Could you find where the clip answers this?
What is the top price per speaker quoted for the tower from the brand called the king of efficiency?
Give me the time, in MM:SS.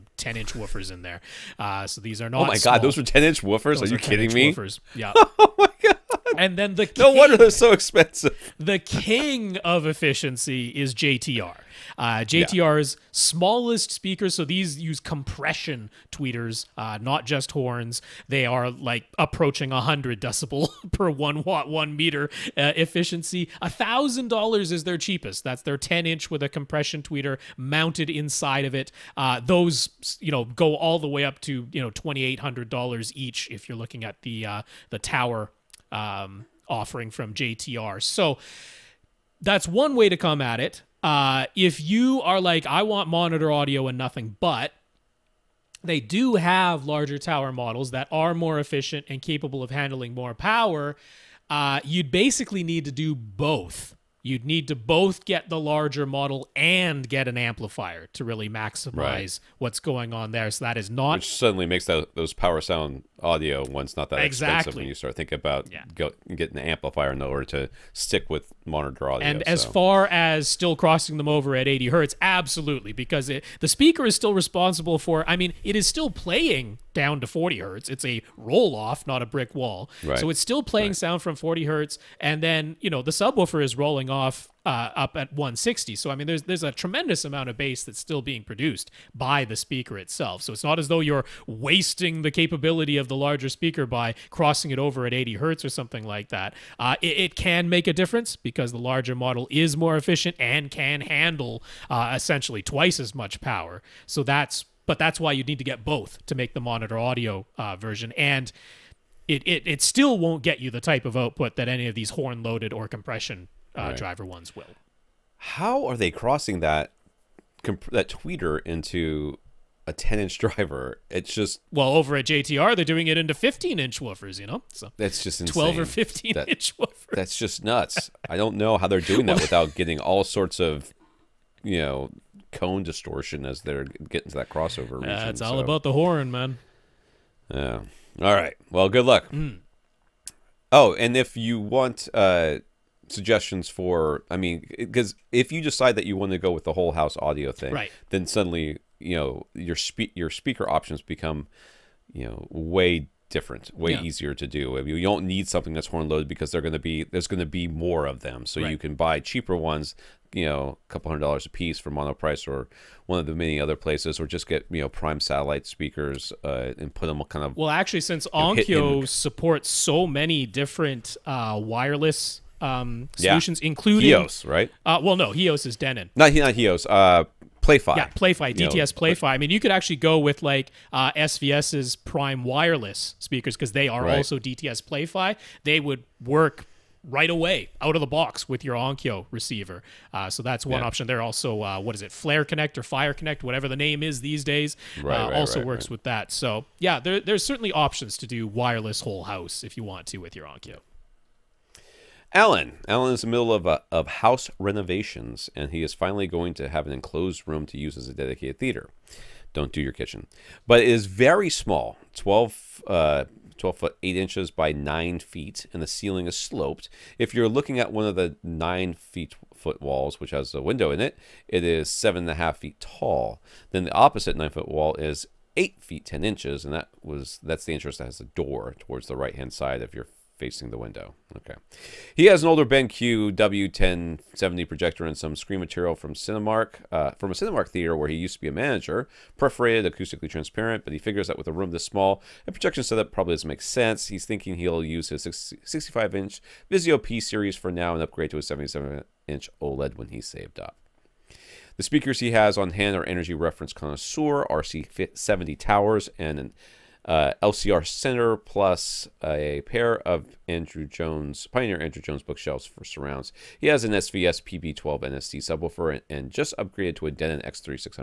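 00:31.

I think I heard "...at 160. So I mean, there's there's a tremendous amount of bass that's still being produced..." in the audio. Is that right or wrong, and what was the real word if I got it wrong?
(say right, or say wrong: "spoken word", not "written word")
right.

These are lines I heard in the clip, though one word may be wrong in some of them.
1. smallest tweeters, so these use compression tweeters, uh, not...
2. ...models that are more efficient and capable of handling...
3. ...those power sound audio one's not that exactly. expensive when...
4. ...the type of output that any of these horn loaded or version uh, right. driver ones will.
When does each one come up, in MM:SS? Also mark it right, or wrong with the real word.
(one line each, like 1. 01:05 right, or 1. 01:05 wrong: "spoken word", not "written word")
1. 00:13 wrong: "speakers", not "tweeters"
2. 00:47 right
3. 01:02 right
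4. 01:50 wrong: "compression", not "version".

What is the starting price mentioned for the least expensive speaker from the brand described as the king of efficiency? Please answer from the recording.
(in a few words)
$1,000.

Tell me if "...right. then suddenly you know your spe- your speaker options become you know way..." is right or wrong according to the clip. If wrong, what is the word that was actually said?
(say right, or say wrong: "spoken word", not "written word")
right.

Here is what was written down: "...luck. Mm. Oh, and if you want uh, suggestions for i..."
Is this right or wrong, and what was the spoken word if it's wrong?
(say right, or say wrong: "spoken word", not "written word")
right.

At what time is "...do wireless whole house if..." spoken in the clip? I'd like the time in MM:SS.
03:18.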